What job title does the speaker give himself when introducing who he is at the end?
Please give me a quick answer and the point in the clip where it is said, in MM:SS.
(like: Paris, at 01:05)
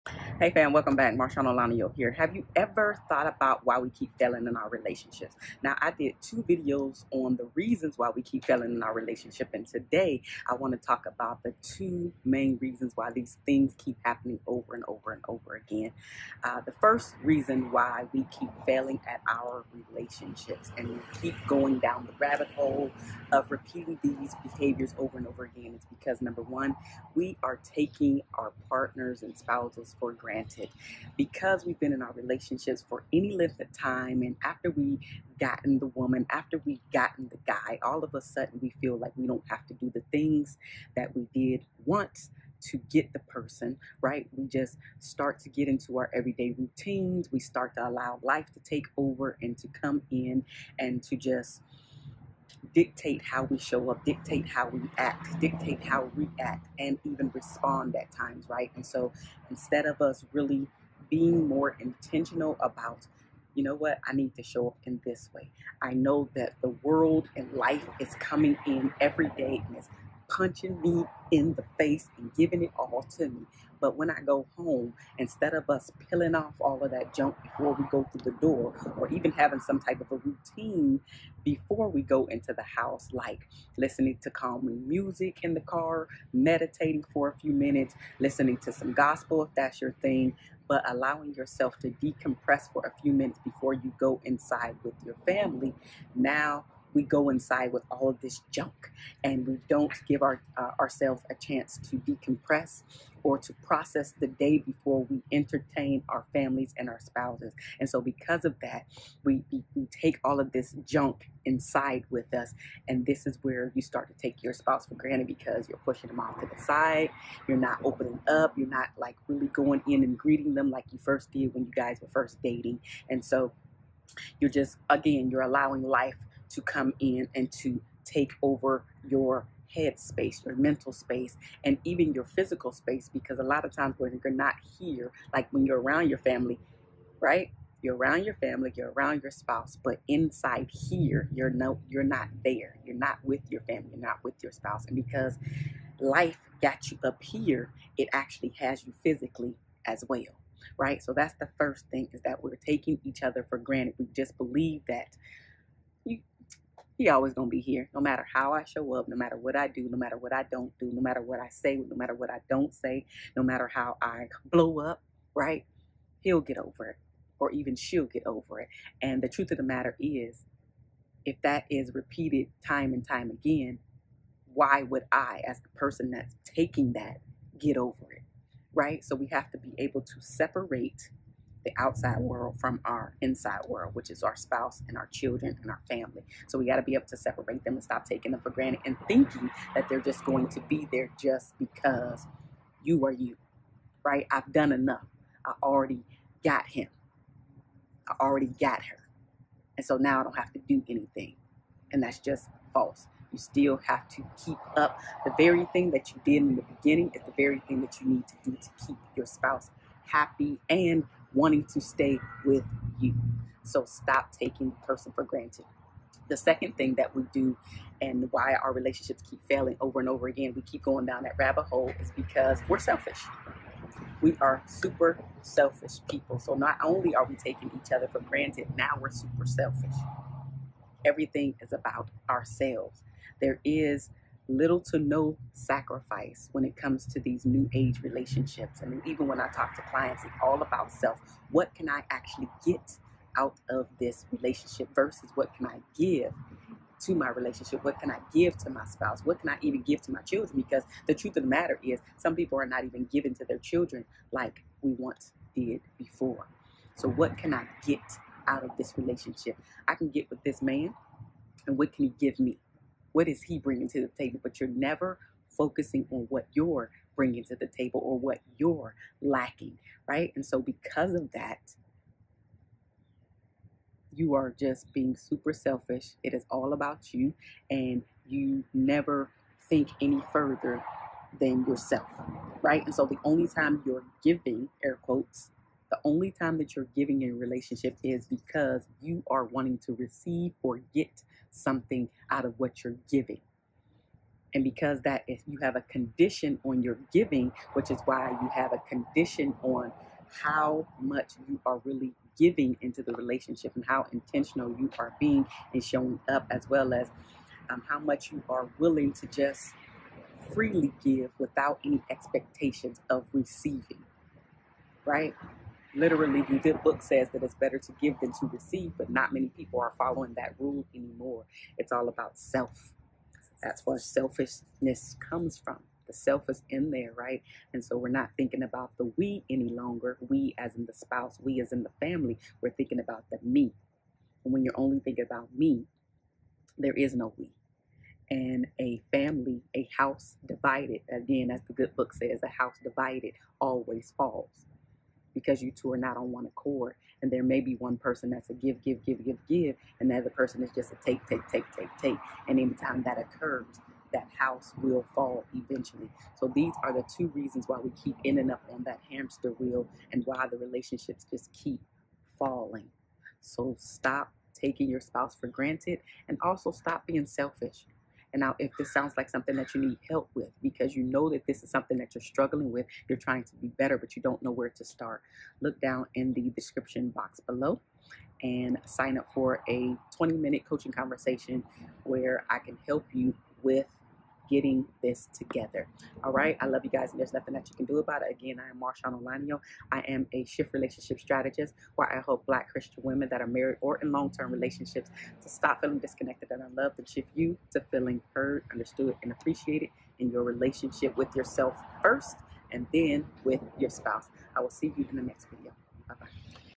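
shift relationship strategist, at 06:30.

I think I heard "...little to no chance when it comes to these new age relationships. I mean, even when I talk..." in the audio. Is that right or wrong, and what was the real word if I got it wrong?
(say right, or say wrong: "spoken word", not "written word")
wrong: "sacrifice", not "chance".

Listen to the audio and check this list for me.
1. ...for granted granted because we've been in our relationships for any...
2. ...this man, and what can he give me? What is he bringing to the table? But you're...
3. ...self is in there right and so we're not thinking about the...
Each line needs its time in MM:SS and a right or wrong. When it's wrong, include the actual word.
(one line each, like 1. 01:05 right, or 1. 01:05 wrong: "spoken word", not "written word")
1. 00:29 right
2. 04:20 right
3. 05:26 right.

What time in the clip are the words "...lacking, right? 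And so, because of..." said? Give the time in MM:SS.
04:29.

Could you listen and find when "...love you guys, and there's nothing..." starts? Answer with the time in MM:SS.
06:26.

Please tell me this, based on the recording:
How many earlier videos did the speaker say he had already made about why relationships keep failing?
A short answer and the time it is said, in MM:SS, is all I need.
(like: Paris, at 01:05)
2, at 00:06.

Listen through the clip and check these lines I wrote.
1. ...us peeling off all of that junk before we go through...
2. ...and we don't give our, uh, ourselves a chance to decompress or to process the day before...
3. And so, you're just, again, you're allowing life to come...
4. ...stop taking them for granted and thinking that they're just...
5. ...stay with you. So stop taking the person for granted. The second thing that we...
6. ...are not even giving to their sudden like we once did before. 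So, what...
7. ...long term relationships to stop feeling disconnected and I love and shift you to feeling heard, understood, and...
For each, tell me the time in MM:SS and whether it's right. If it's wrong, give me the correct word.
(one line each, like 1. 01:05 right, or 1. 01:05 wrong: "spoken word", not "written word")
1. 01:15 right
2. 01:39 right
3. 02:03 right
4. 03:07 right
5. 03:31 right
6. 04:12 wrong: "children", not "sudden"
7. 06:34 right.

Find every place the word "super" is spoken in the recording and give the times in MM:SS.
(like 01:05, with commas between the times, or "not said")
03:44, 03:49, 04:35.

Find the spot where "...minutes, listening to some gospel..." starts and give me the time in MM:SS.
01:27.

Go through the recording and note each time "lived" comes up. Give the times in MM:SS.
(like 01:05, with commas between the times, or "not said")
not said.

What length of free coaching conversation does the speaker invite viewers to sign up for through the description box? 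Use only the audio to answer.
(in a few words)
20 minutes.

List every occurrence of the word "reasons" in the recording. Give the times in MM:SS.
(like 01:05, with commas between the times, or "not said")
00:07, 00:12, 00:17, 05:57.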